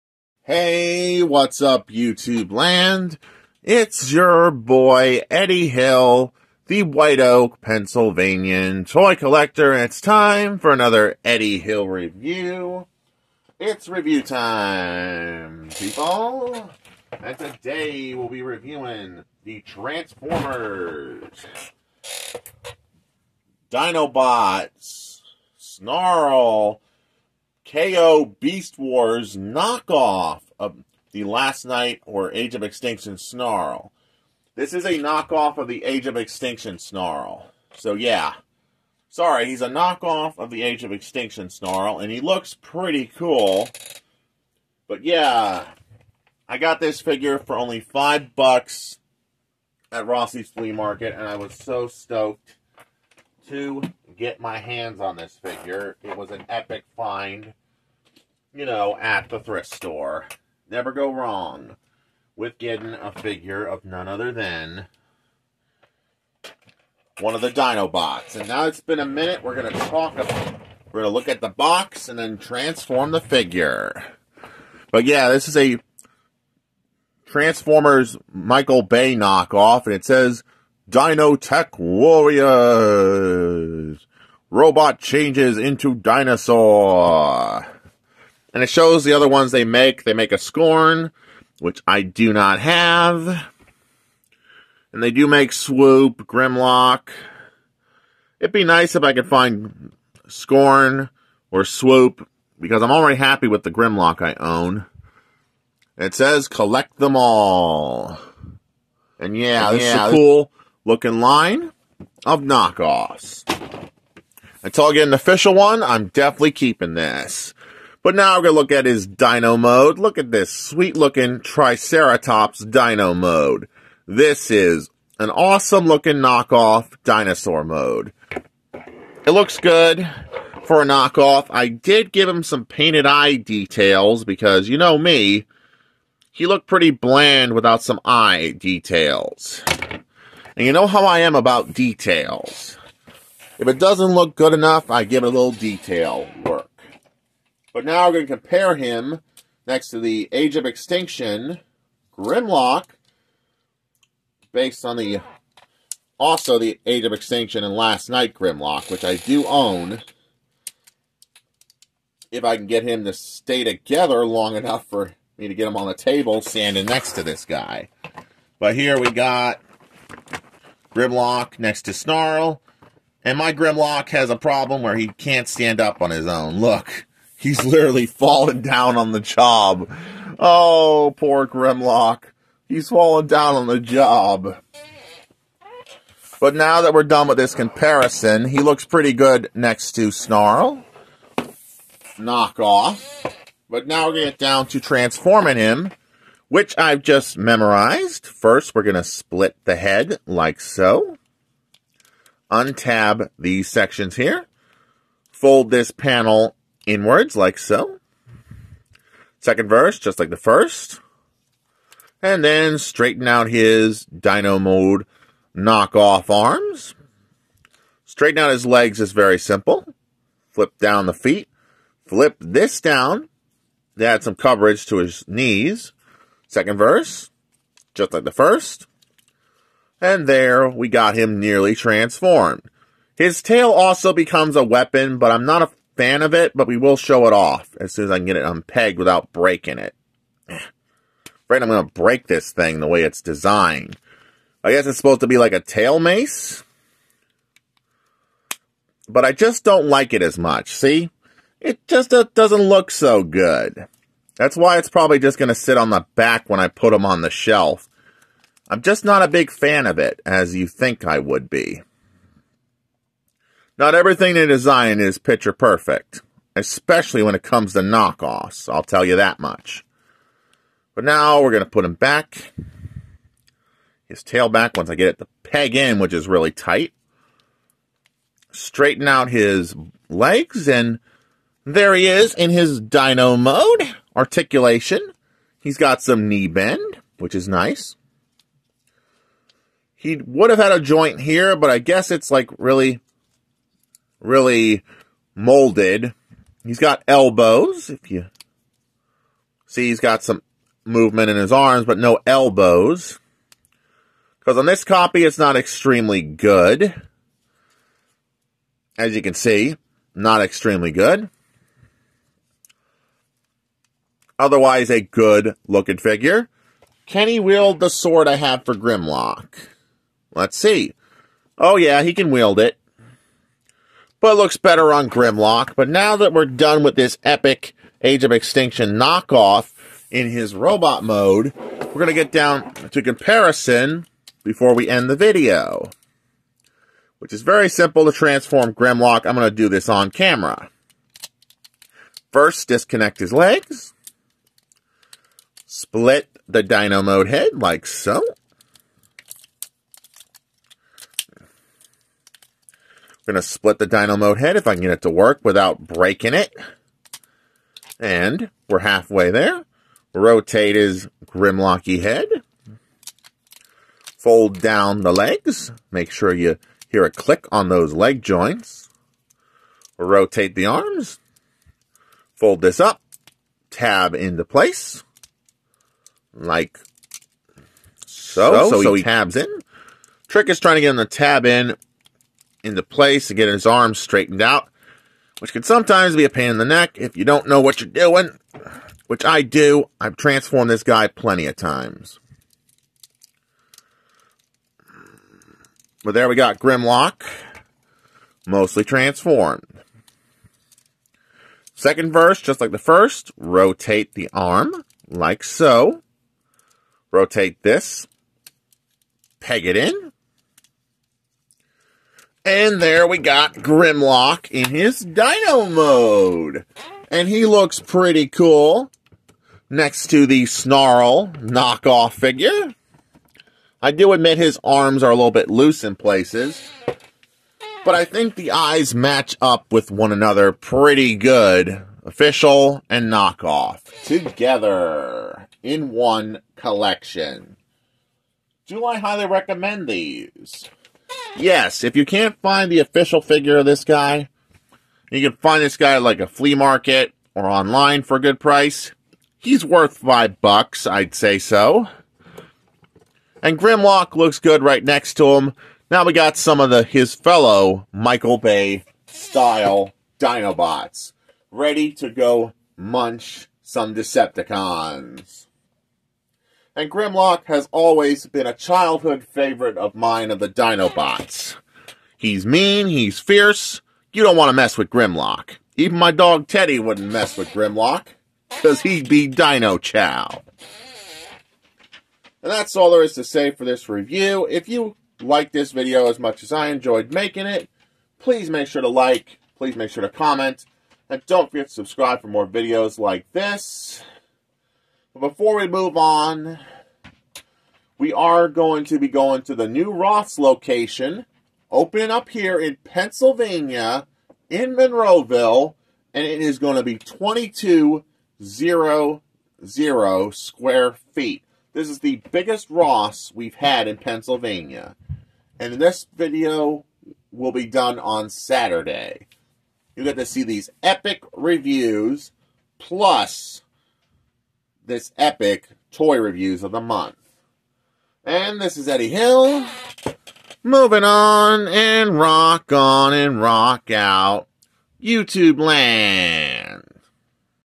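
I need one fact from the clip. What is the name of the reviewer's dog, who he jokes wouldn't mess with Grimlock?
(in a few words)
Teddy.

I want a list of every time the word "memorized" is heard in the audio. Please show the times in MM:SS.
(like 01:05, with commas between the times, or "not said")
03:17.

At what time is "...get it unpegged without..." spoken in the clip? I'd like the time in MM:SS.
03:58.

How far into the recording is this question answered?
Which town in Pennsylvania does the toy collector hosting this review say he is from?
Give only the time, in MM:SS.
00:06.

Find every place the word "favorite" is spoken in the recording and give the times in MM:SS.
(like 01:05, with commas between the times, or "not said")
07:49.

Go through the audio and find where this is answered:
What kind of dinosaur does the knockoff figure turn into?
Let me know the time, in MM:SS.
02:01.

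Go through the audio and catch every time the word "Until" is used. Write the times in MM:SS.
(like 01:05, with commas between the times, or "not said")
01:54.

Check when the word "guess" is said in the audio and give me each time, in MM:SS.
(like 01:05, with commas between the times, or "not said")
04:04, 04:51.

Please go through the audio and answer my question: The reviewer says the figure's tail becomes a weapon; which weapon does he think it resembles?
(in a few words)
Tail mace.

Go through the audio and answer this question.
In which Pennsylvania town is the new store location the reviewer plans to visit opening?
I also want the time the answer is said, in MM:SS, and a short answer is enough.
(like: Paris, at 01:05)
Monroeville, at 08:24.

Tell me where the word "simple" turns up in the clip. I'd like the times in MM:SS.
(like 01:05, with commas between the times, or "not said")
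03:39, 05:37.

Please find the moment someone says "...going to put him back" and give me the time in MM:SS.
04:31.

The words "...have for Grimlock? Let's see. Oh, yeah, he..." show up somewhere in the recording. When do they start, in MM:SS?
05:18.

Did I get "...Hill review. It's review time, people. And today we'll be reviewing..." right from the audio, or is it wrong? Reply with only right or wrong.
right.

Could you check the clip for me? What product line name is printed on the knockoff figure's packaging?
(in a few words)
Dino Tech Warriors.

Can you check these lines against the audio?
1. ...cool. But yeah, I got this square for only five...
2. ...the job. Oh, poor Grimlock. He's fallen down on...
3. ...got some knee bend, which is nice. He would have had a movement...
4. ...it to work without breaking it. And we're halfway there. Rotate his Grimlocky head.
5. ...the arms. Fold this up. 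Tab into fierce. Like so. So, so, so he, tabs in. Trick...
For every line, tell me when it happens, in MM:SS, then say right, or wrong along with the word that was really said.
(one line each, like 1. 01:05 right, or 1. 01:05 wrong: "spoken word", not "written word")
1. 00:43 wrong: "figure", not "square"
2. 02:59 right
3. 04:45 wrong: "joint", not "movement"
4. 05:54 right
5. 06:10 wrong: "place", not "fierce".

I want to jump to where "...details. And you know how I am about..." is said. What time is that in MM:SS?
02:18.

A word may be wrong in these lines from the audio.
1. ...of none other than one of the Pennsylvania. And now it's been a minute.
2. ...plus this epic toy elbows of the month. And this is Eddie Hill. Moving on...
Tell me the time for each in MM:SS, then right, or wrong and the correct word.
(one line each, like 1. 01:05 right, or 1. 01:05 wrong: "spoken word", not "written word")
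1. 01:03 wrong: "Dinobots", not "Pennsylvania"
2. 08:42 wrong: "reviews", not "elbows".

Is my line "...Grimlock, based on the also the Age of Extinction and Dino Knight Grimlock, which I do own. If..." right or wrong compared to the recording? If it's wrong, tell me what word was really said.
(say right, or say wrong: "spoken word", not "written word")
wrong: "Last", not "Dino".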